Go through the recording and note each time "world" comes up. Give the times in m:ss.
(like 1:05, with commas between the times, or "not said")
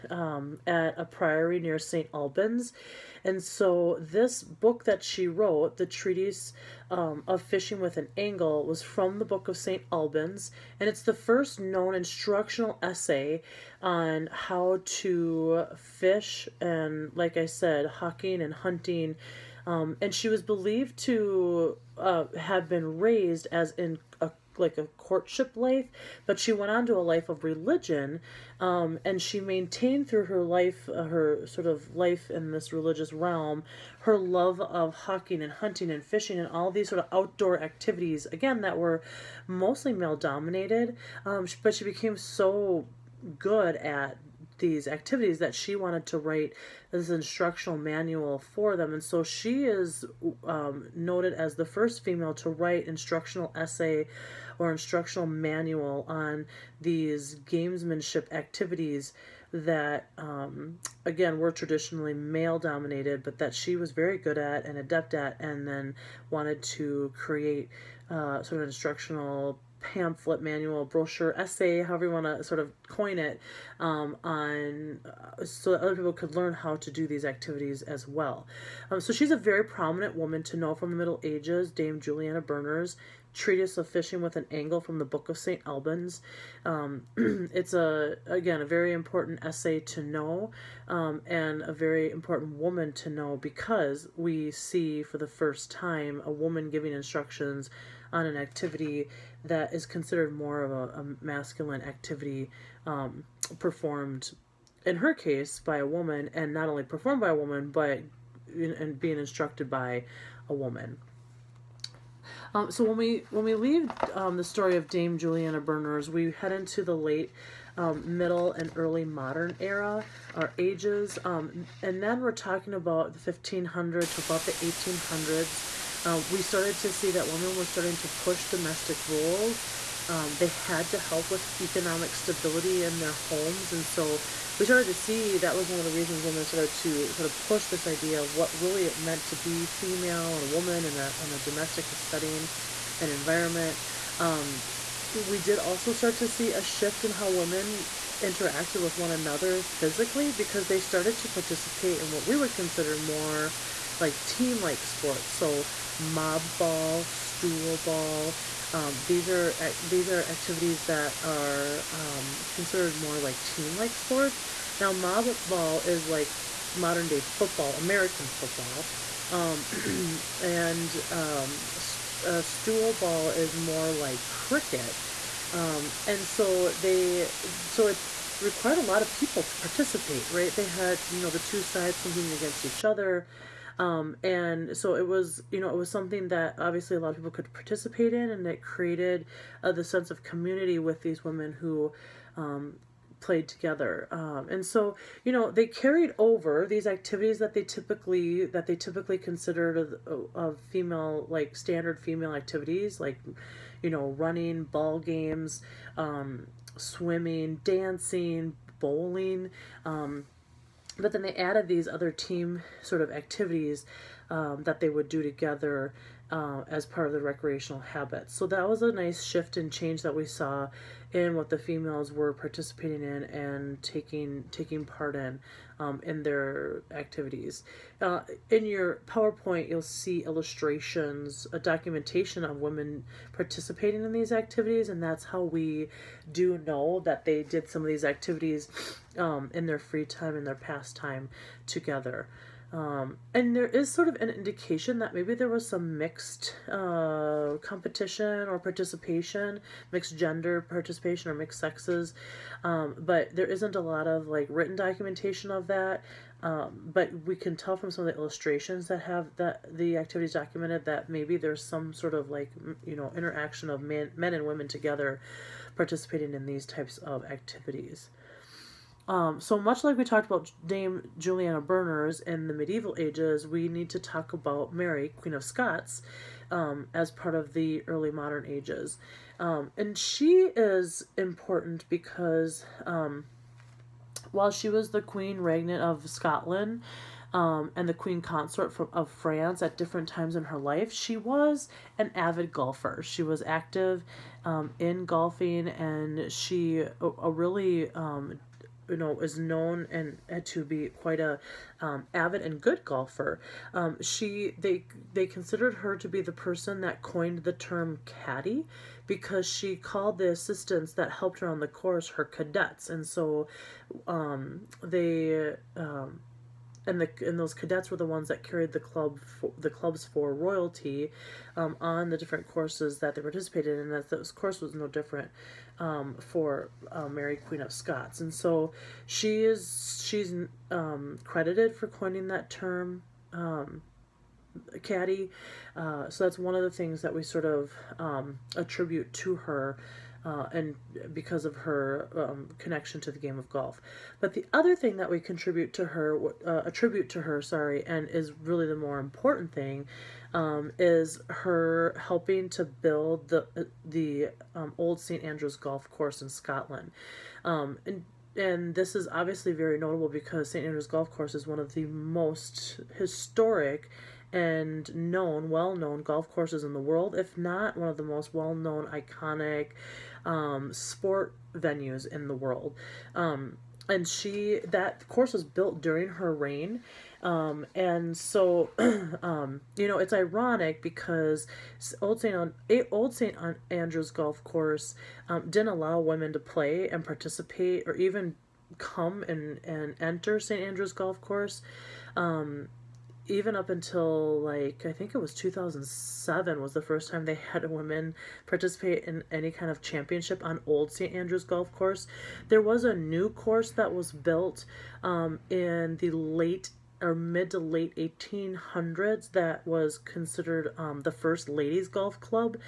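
6:06, 6:12.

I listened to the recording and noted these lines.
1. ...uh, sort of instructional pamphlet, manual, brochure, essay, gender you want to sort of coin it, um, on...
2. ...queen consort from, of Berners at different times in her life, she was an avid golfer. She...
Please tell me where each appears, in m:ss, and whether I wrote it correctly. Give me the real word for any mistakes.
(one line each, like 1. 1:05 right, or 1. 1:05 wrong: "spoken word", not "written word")
1. 1:08 wrong: "however", not "gender"
2. 4:47 wrong: "France", not "Berners".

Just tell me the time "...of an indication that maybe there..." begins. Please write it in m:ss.
4:04.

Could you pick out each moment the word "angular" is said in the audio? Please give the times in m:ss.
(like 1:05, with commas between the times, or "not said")
not said.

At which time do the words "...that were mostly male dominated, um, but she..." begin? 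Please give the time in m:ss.
0:38.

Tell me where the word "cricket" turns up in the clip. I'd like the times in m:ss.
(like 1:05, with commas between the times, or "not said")
2:54.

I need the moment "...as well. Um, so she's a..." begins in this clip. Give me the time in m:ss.
1:17.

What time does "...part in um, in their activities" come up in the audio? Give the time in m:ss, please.
3:44.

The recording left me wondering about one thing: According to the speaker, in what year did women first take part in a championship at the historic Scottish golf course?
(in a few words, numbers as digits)
2007.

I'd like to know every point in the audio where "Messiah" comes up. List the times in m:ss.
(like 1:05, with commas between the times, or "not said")
not said.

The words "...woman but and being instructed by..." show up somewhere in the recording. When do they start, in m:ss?
1:47.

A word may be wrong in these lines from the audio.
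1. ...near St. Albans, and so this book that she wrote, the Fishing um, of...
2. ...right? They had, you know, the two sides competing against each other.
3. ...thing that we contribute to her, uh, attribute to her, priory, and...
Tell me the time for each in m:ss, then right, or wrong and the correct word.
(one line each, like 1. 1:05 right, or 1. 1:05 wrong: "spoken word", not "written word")
1. 0:01 wrong: "Treatise", not "Fishing"
2. 3:00 right
3. 5:44 wrong: "sorry", not "priory".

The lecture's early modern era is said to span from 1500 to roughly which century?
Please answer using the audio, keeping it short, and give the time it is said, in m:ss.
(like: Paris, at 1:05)
1800s, at 2:04.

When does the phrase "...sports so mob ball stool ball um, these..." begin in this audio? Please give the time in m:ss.
2:34.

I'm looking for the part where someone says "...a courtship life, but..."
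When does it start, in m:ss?
0:24.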